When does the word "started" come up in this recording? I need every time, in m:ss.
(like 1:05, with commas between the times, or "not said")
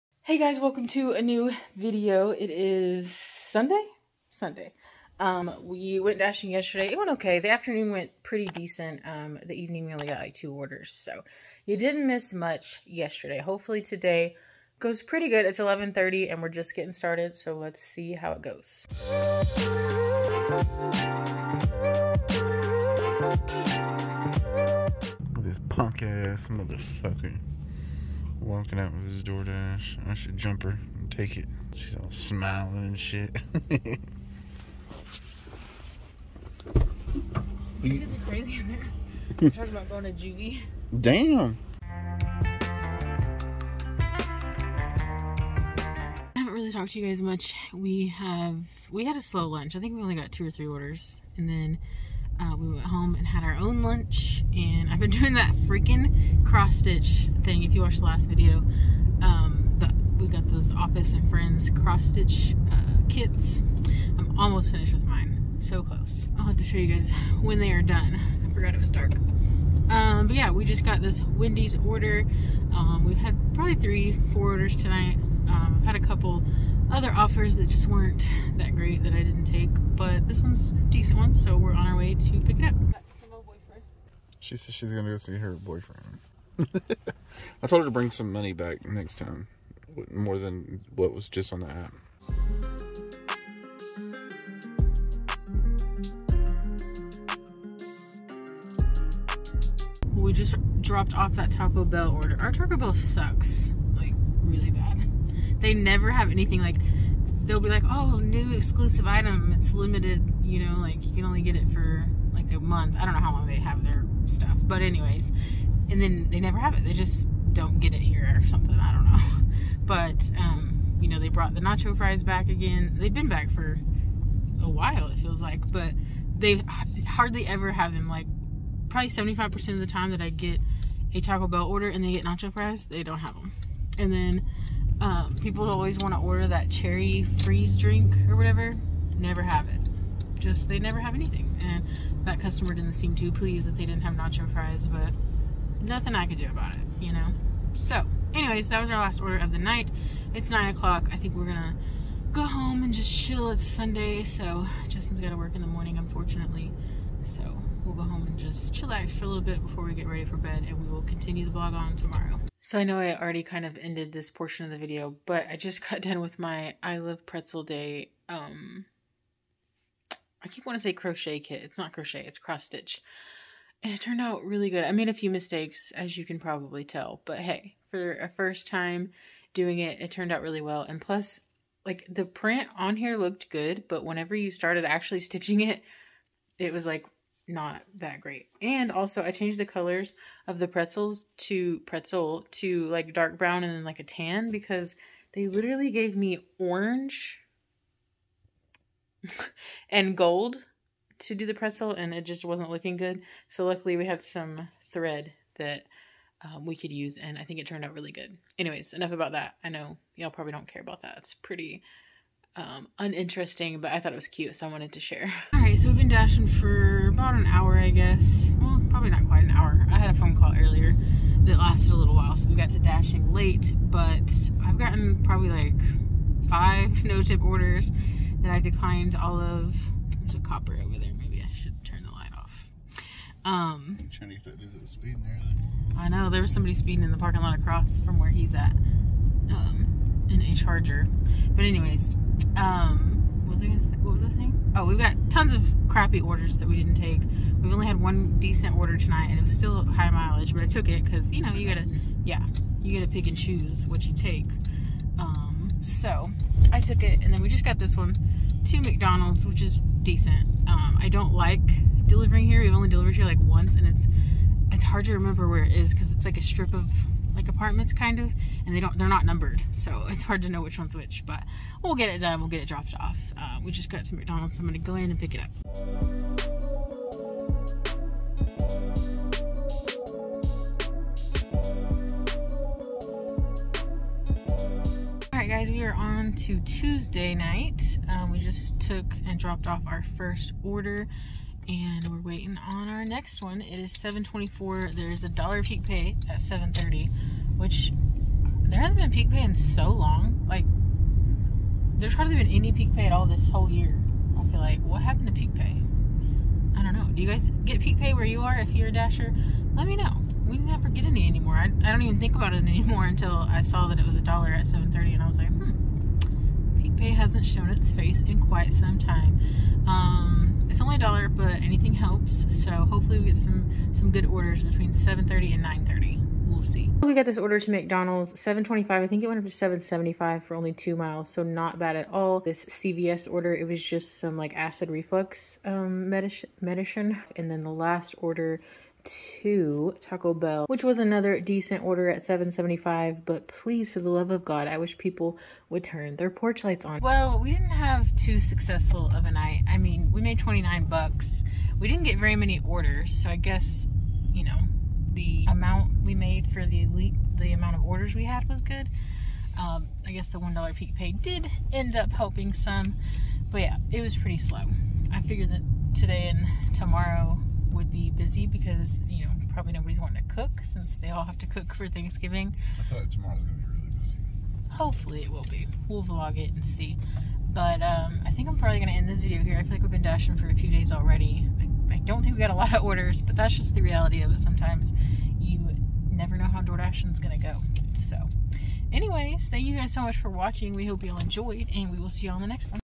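0:16, 3:04.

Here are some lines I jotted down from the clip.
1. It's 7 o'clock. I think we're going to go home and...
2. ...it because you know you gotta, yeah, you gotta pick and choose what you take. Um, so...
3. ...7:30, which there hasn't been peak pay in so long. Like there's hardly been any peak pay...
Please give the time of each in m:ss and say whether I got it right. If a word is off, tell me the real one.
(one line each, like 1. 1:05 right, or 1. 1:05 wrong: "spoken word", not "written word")
1. 2:30 wrong: "9", not "7"
2. 4:10 right
3. 4:56 right.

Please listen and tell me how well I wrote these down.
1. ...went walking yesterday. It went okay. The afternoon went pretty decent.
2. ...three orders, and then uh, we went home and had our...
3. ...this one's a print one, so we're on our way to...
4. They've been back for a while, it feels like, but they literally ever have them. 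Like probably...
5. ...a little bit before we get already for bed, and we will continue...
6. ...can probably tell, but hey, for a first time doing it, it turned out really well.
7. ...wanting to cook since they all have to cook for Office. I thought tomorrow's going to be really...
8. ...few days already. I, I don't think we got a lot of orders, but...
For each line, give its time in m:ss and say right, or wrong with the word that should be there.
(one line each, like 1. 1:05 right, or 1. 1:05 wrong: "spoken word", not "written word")
1. 0:05 wrong: "dashing", not "walking"
2. 0:50 right
3. 1:20 wrong: "decent", not "print"
4. 2:02 wrong: "hardly", not "literally"
5. 2:39 wrong: "ready", not "already"
6. 2:56 right
7. 6:09 wrong: "Thanksgiving", not "Office"
8. 6:20 right.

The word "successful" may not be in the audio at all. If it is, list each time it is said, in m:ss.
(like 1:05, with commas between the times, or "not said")
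5:48.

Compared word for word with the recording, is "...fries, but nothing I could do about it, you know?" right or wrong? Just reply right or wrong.
right.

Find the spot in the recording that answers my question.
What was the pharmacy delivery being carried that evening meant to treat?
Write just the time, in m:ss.
5:34.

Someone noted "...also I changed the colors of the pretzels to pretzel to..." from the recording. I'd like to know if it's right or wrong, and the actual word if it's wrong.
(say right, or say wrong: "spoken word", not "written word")
right.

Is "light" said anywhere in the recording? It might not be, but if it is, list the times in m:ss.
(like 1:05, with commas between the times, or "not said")
3:52, 5:46.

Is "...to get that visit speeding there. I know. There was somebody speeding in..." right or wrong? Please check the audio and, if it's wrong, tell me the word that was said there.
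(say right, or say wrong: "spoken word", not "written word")
right.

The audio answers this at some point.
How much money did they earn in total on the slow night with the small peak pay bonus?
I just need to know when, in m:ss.
5:50.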